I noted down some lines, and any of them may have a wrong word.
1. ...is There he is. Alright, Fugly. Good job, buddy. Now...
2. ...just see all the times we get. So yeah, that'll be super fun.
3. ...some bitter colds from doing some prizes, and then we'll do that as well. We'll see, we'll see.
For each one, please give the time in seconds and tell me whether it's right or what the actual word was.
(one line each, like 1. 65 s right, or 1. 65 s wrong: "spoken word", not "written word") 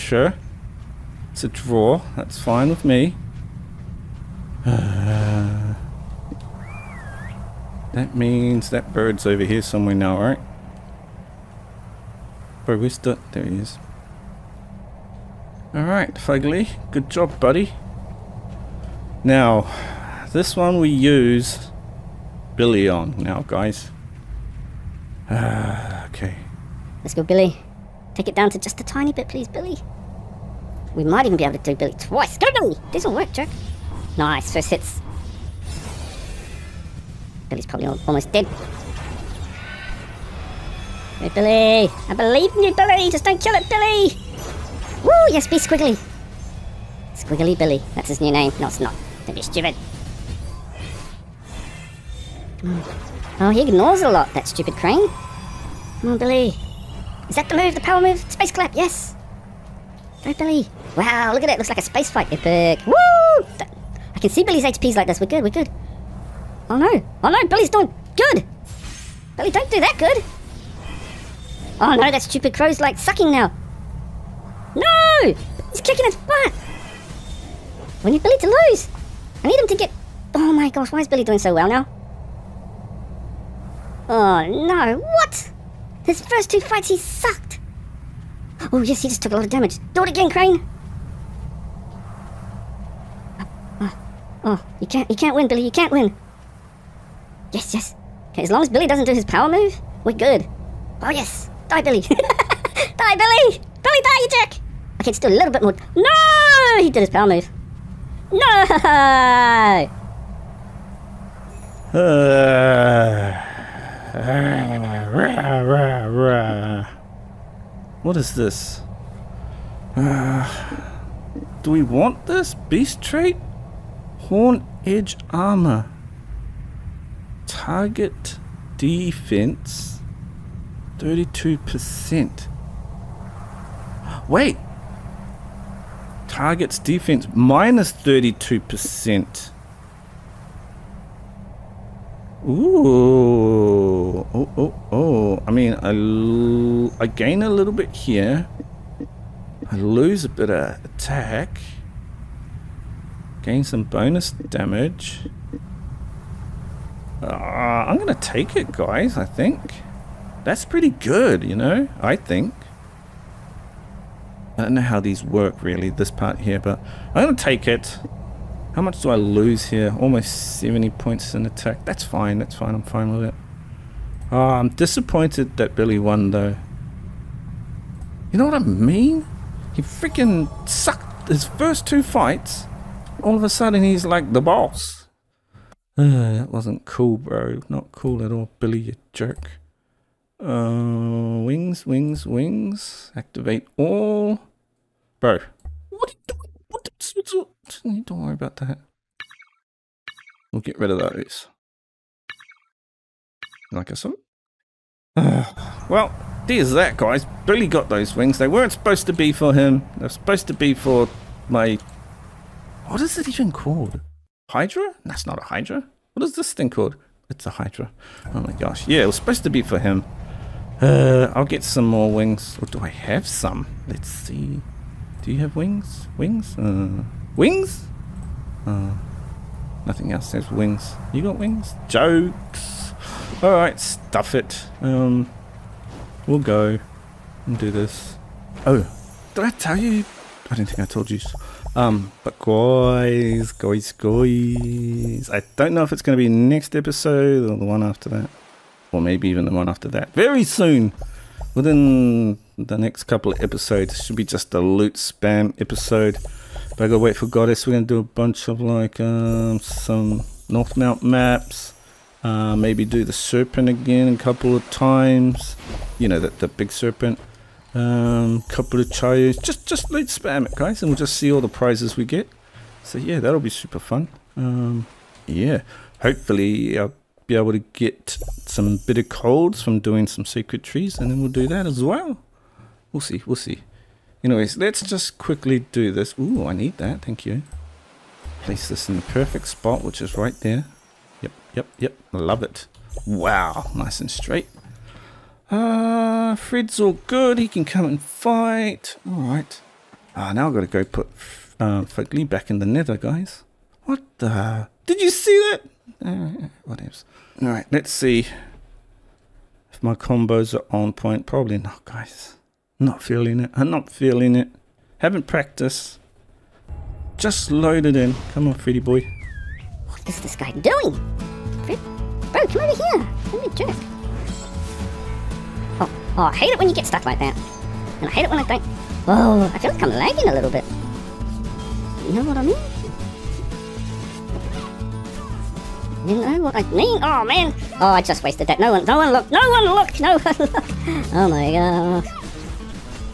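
1. 12 s right
2. 270 s wrong: "prizes", not "times"
3. 278 s wrong: "trees", not "prizes".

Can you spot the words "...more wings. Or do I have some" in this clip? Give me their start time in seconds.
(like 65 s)
221 s.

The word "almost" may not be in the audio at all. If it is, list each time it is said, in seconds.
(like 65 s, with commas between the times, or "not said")
38 s, 169 s.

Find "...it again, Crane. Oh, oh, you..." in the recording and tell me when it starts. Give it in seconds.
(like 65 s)
90 s.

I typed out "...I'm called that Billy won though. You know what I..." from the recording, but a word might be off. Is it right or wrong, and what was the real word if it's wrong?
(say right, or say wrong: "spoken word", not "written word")
wrong: "disappointed", not "called".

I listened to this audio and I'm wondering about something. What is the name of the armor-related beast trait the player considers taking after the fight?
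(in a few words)
Horn edge armor.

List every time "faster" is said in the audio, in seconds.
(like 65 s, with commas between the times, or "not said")
not said.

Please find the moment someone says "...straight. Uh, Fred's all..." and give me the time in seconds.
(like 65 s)
294 s.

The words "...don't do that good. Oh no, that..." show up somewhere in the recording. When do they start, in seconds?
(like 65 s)
69 s.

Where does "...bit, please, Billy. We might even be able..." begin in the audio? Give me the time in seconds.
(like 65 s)
29 s.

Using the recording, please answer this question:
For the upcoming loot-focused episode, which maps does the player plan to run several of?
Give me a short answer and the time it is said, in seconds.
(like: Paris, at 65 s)
North Mount maps, at 260 s.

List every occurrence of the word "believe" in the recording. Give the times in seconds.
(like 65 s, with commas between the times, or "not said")
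42 s.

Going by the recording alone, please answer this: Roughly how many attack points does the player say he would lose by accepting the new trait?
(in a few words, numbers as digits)
70.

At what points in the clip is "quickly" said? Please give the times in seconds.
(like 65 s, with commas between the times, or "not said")
285 s.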